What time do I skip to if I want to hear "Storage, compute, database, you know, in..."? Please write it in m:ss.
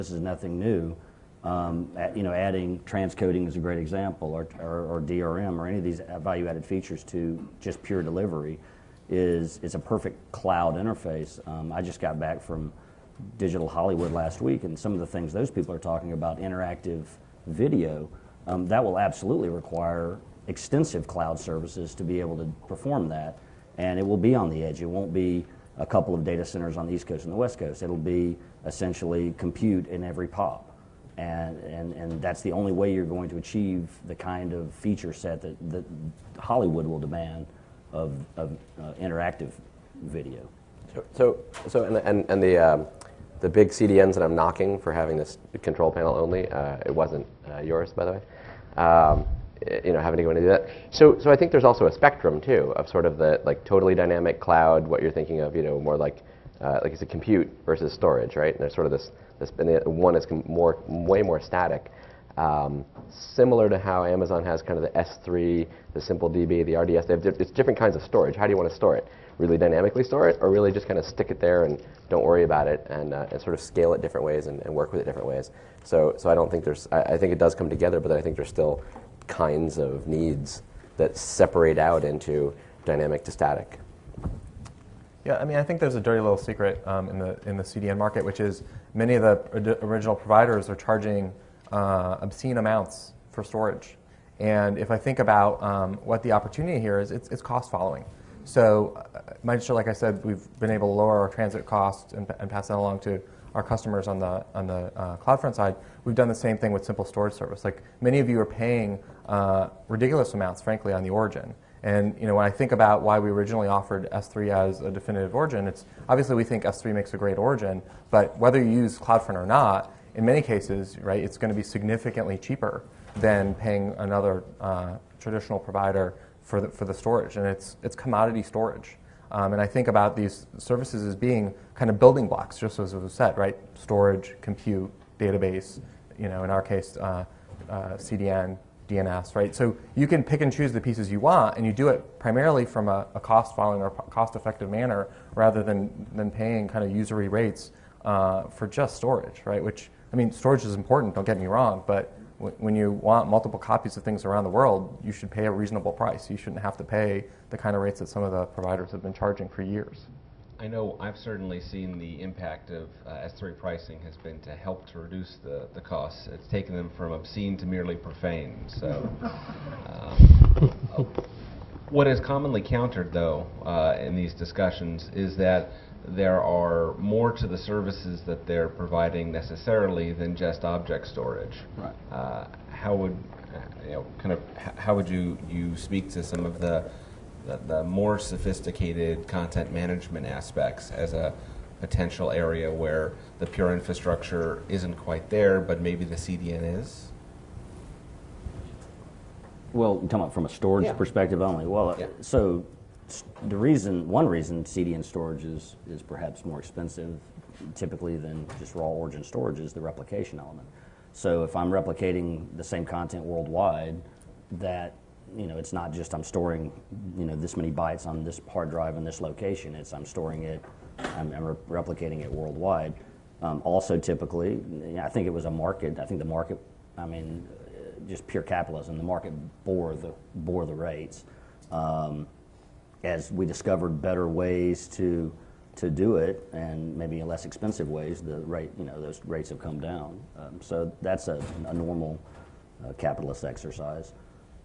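2:13.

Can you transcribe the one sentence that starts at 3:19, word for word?
Well, you're talking about from a storage yeah.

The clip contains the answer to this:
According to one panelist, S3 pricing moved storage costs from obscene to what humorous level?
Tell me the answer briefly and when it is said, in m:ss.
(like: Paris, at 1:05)
merely profane, at 2:47.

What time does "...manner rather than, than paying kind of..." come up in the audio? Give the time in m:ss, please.
2:24.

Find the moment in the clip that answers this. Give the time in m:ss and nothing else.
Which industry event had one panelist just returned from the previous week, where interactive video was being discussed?
0:13.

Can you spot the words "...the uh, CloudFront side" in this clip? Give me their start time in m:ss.
1:44.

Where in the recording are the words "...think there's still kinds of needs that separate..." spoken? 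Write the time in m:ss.
1:18.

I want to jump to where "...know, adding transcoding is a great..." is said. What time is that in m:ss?
0:02.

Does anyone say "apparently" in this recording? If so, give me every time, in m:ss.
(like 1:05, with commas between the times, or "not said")
not said.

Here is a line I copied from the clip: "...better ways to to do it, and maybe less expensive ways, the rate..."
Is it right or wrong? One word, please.
right.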